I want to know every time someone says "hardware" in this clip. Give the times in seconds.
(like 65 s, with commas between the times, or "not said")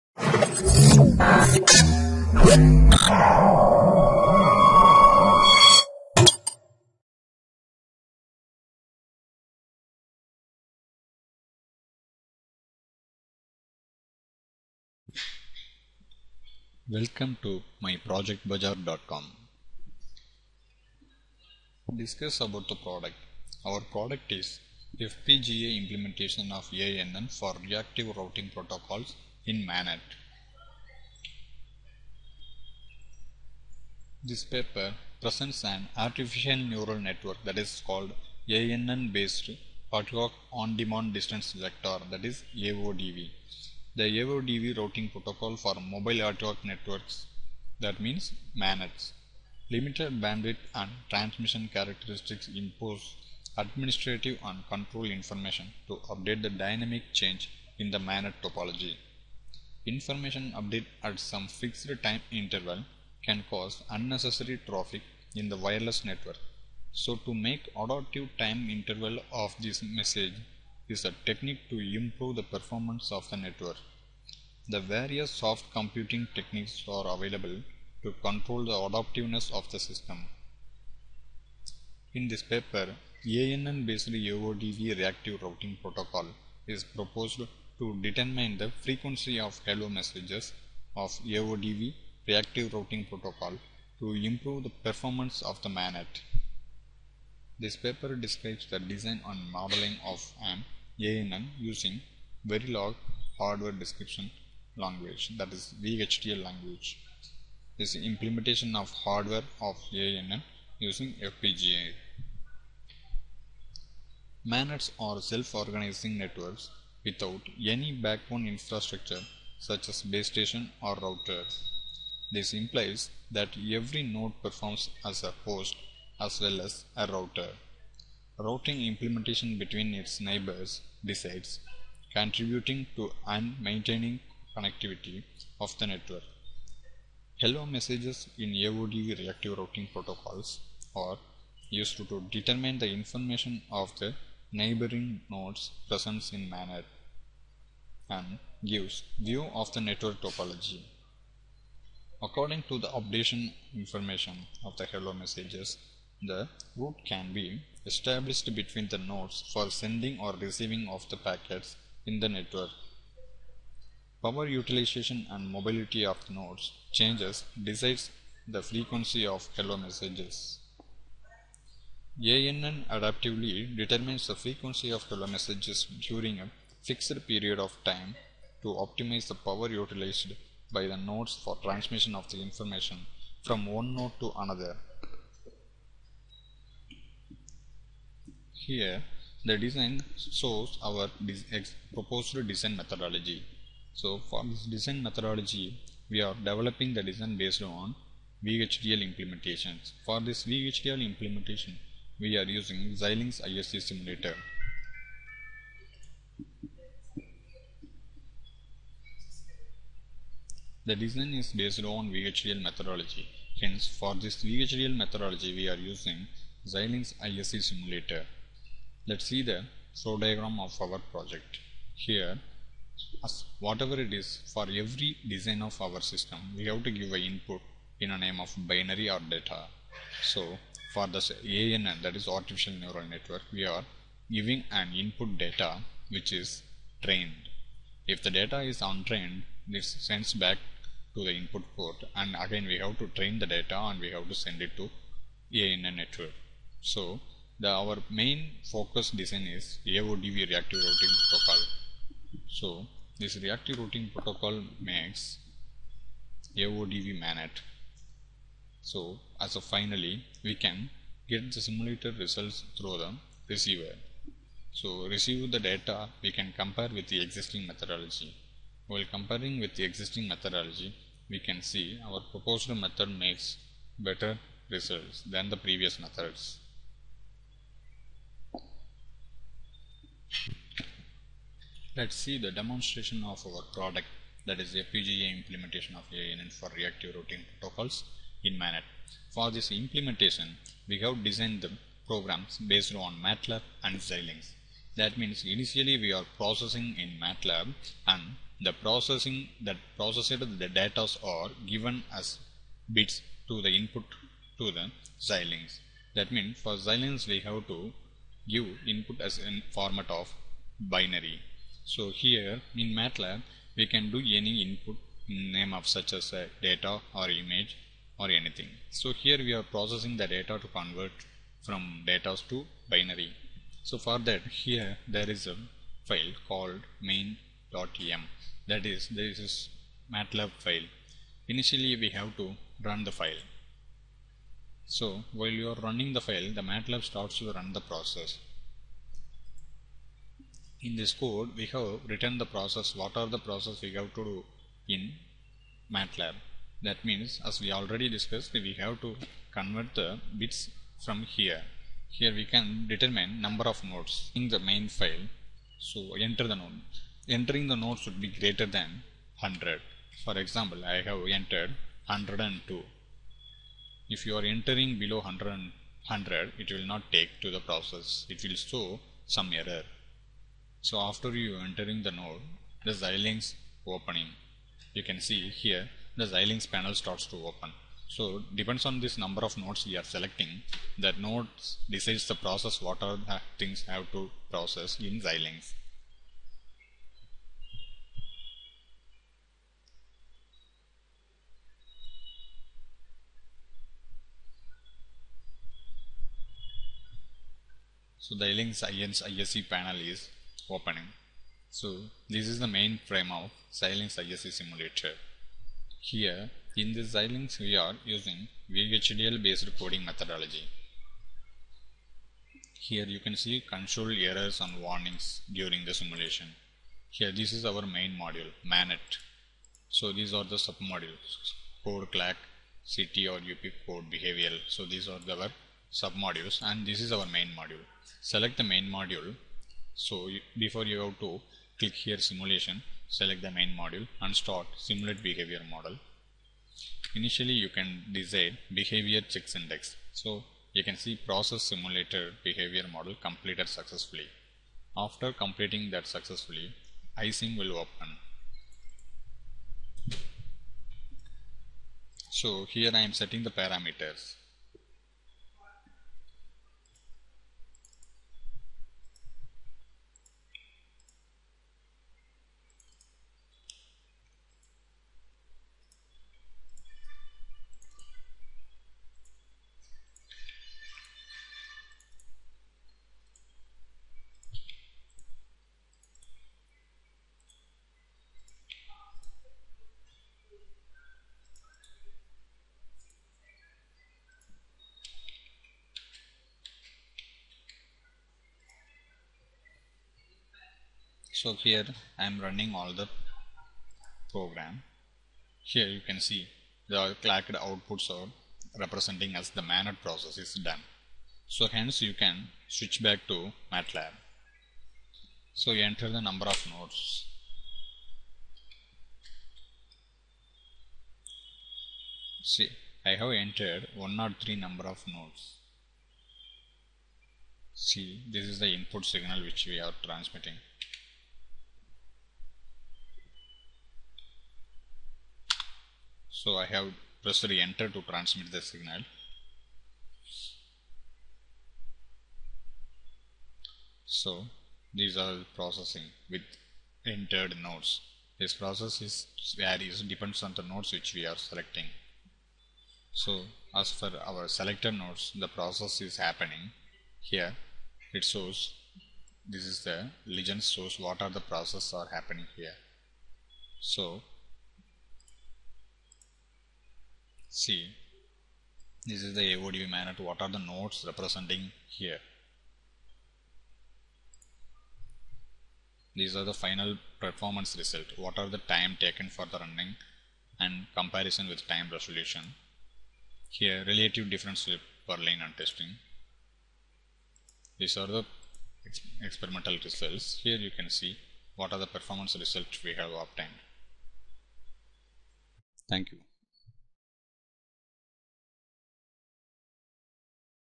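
103 s, 108 s.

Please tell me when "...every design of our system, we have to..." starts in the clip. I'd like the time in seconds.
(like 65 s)
224 s.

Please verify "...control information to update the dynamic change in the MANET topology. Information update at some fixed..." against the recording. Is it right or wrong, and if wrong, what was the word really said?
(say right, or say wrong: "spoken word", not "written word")
right.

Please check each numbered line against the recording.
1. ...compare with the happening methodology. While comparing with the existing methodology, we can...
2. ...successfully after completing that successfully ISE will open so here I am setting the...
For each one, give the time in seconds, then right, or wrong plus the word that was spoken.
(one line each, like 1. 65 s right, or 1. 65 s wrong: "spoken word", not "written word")
1. 266 s wrong: "existing", not "happening"
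2. 443 s wrong: "ISim", not "ISE".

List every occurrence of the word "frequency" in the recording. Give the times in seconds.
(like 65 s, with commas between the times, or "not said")
88 s, 168 s, 174 s.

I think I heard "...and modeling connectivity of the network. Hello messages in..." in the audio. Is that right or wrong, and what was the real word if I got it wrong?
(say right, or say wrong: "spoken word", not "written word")
wrong: "maintaining", not "modeling".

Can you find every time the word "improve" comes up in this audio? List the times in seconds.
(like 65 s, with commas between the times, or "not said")
71 s, 94 s.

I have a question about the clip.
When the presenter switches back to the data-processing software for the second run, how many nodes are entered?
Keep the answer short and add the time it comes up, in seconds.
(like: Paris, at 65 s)
103, at 513 s.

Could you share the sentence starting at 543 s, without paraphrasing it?
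So as for our selected nodes, the process is happening here.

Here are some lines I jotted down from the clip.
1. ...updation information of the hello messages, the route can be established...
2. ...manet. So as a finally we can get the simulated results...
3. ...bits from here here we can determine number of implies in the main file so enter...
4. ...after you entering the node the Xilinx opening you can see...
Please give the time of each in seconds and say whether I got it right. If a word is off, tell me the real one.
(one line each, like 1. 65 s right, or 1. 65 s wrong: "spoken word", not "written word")
1. 152 s right
2. 257 s right
3. 350 s wrong: "nodes", not "implies"
4. 371 s right.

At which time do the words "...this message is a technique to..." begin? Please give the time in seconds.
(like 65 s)
69 s.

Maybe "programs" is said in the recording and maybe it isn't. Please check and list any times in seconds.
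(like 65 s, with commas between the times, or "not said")
292 s, 494 s.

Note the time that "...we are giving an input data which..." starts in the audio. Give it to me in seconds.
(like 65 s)
233 s.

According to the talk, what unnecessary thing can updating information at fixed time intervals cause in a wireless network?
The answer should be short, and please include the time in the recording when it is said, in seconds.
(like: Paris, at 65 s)
traffic, at 64 s.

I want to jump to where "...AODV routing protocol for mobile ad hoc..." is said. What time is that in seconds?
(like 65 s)
44 s.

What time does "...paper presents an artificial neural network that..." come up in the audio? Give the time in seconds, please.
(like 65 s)
34 s.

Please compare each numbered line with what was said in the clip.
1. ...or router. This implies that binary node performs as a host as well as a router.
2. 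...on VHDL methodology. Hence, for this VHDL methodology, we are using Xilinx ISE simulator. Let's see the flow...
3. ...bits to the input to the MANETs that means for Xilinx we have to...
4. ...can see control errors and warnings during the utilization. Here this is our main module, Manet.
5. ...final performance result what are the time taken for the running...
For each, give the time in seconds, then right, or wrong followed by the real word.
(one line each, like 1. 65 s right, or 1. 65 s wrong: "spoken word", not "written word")
1. 120 s wrong: "every", not "binary"
2. 211 s right
3. 302 s wrong: "Xilinx", not "MANETs"
4. 413 s wrong: "simulation", not "utilization"
5. 566 s right.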